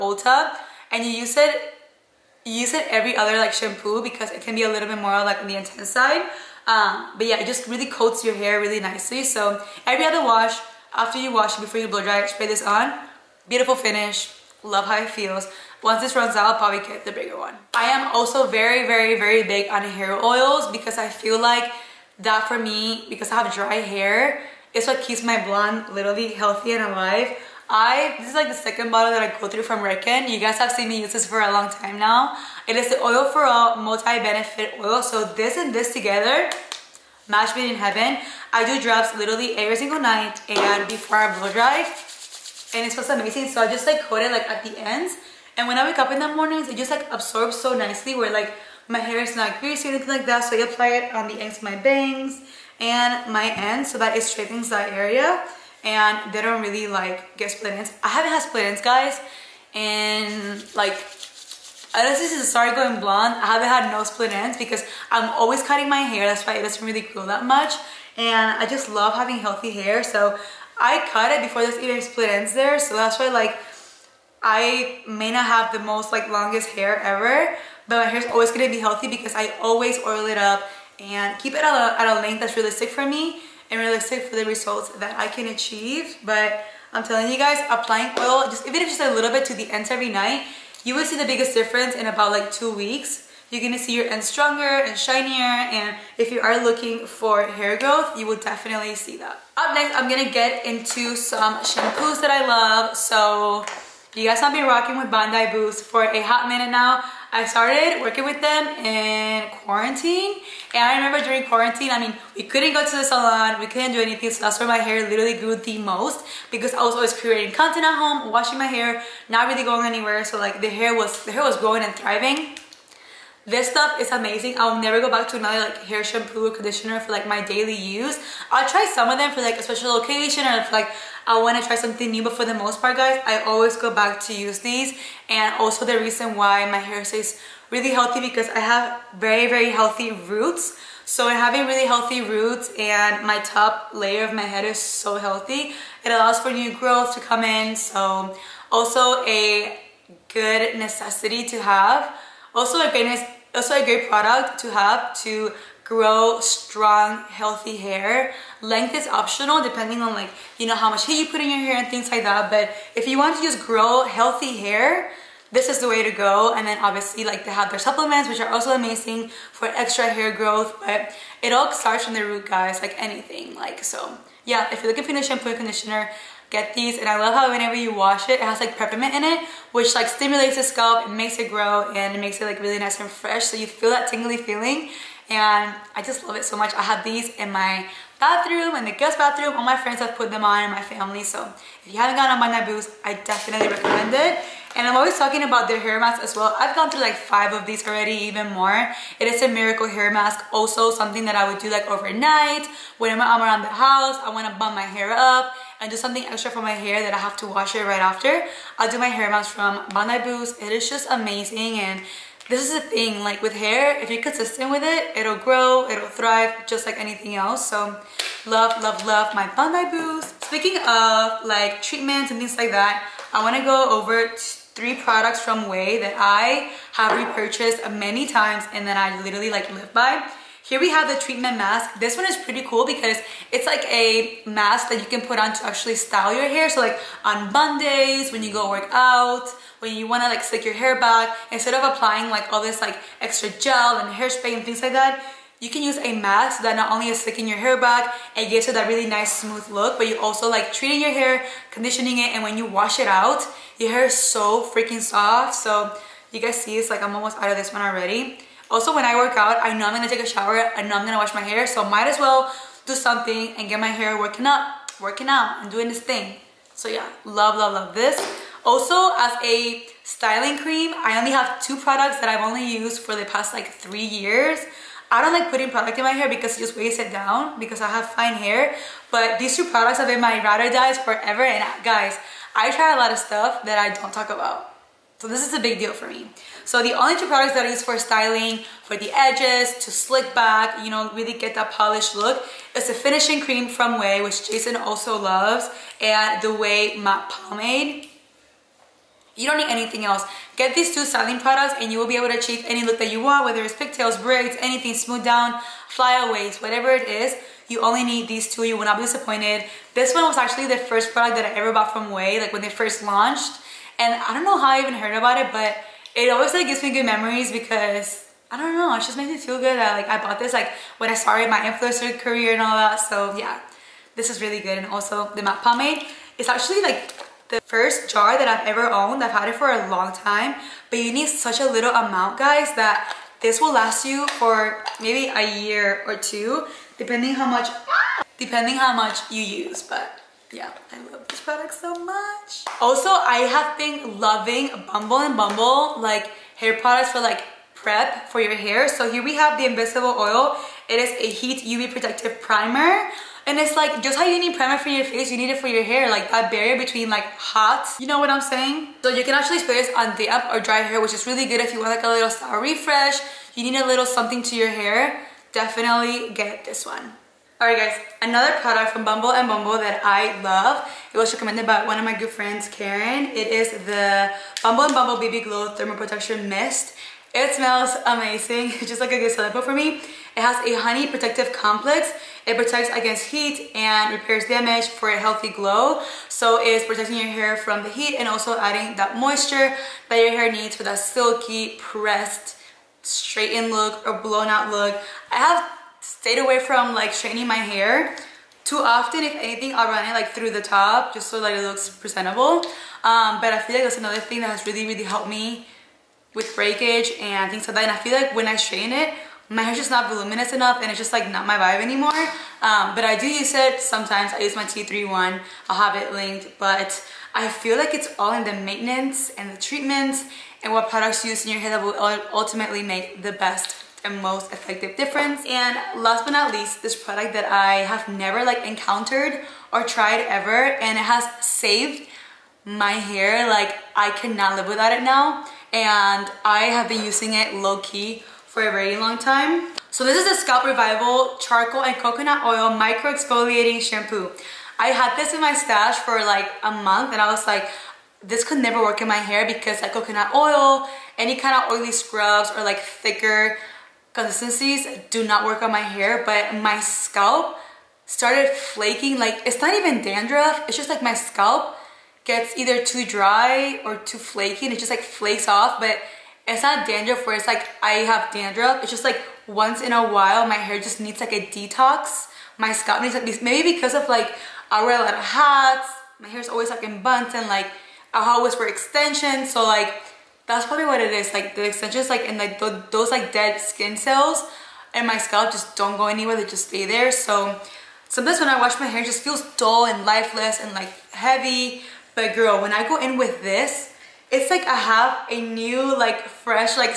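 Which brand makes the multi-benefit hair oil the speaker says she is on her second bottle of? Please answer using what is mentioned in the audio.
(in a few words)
Redken.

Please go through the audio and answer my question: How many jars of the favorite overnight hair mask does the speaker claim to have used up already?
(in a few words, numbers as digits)
5.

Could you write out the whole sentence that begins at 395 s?
I have stayed away from like straightening my hair too often.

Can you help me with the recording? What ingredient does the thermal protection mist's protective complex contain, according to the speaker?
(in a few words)
Honey.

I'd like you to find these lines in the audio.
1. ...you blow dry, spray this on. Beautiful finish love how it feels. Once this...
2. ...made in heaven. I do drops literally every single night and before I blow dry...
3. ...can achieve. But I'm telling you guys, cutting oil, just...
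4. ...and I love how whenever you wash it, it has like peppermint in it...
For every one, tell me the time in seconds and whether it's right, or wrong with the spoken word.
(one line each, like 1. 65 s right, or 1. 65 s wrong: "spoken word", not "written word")
1. 11 s right
2. 37 s right
3. 85 s wrong: "applying", not "cutting"
4. 176 s right.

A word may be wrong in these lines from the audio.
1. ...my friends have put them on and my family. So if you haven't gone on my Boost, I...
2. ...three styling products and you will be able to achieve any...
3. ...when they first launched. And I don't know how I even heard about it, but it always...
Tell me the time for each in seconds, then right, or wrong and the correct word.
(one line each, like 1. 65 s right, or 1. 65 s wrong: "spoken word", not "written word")
1. 189 s right
2. 300 s wrong: "two", not "three"
3. 312 s right.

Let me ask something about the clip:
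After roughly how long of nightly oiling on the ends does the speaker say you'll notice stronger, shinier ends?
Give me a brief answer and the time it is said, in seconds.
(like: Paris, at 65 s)
2 weeks, at 92 s.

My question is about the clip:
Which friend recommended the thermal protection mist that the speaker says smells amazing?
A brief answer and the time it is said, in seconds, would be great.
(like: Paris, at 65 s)
Karen, at 372 s.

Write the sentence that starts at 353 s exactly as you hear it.
And it's like, just how you need primer for your face, you need it for your hair.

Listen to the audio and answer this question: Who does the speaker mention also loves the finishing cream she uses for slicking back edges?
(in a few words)
Jason.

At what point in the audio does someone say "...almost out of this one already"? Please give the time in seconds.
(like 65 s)
257 s.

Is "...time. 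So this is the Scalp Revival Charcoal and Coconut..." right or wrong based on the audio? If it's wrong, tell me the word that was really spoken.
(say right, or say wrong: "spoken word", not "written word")
right.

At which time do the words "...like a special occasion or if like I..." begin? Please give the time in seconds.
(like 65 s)
129 s.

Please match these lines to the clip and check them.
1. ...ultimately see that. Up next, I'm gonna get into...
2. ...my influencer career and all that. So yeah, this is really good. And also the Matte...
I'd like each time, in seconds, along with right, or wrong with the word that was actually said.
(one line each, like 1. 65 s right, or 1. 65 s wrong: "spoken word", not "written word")
1. 98 s wrong: "definitely", not "ultimately"
2. 321 s right.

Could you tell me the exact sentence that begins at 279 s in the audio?
But these two products have been my router dies forever.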